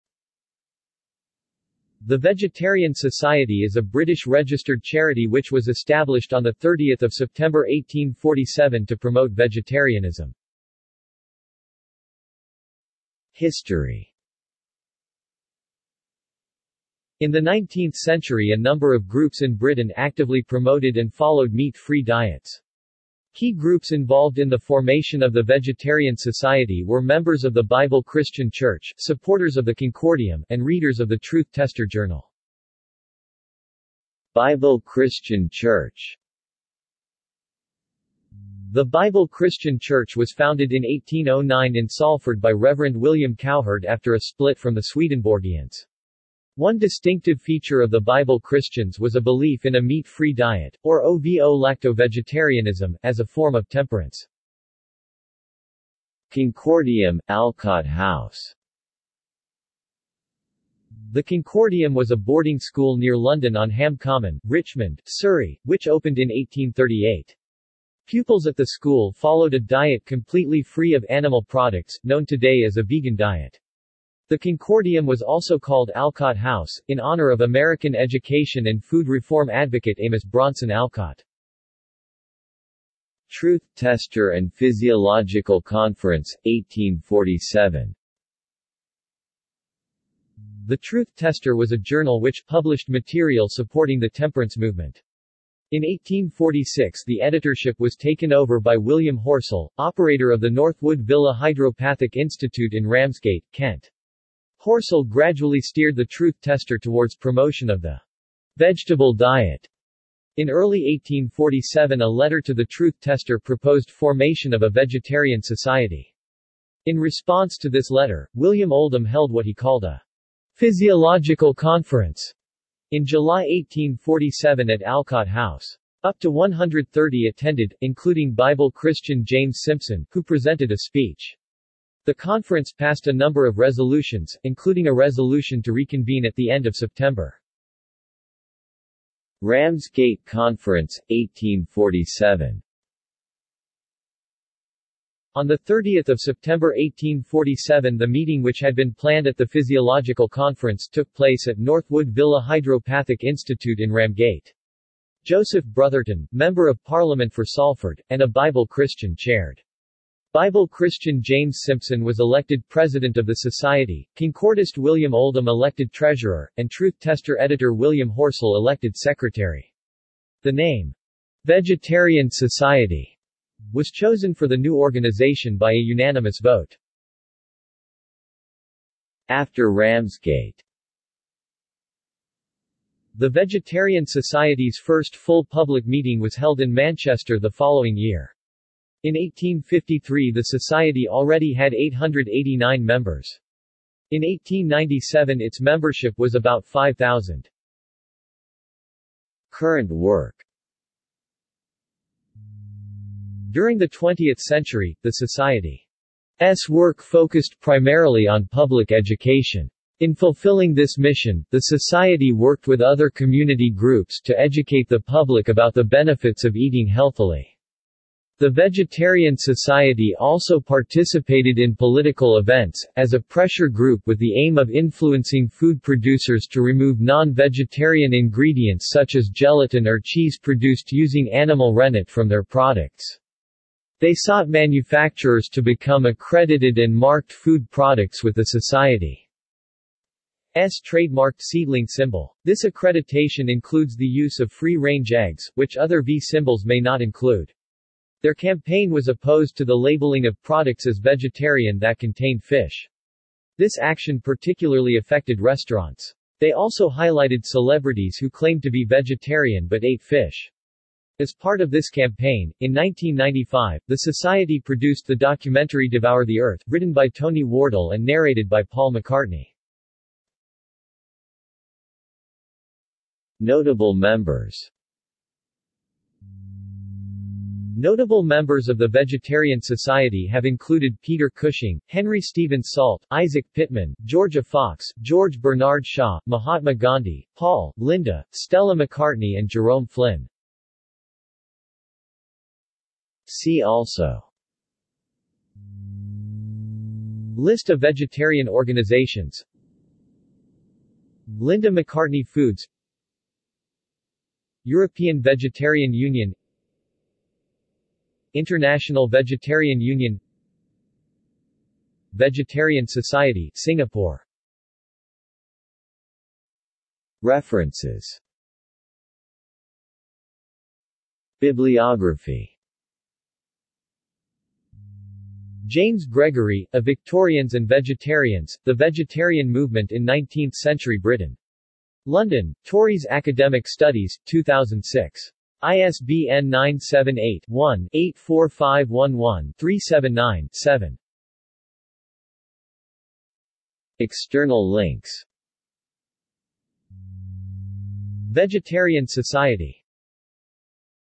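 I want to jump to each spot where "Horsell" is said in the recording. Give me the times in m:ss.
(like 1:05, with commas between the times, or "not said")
1:39, 1:44, 2:48.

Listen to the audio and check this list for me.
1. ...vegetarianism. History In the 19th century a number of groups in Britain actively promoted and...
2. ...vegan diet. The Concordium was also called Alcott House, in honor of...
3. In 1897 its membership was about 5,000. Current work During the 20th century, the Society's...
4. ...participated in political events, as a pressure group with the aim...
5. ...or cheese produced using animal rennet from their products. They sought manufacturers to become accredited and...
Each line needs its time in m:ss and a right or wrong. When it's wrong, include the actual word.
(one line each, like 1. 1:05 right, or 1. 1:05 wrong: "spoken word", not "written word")
1. 0:09 right
2. 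1:12 right
3. 3:14 right
4. 3:40 right
5. 3:49 right.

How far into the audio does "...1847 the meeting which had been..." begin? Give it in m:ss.
2:26.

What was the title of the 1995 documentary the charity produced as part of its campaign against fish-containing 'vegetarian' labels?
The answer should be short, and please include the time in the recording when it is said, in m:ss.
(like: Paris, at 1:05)
Devour the Earth, at 4:25.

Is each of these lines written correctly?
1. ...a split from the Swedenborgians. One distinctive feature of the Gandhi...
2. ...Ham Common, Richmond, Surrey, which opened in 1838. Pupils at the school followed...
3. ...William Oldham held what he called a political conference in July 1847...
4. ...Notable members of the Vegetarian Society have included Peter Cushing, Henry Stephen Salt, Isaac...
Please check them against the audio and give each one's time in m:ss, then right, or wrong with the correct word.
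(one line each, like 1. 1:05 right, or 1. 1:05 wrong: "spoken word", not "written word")
1. 0:44 wrong: "Bible", not "Gandhi"
2. 1:03 right
3. 1:58 wrong: "physiological", not "political"
4. 4:37 right.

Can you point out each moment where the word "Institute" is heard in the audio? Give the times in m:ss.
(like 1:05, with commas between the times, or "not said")
1:42, 2:33.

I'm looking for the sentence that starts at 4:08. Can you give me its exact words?
Their campaign was opposed to the labeling of products as vegetarian that contained fish.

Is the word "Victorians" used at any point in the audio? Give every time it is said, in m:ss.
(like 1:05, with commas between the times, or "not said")
5:26.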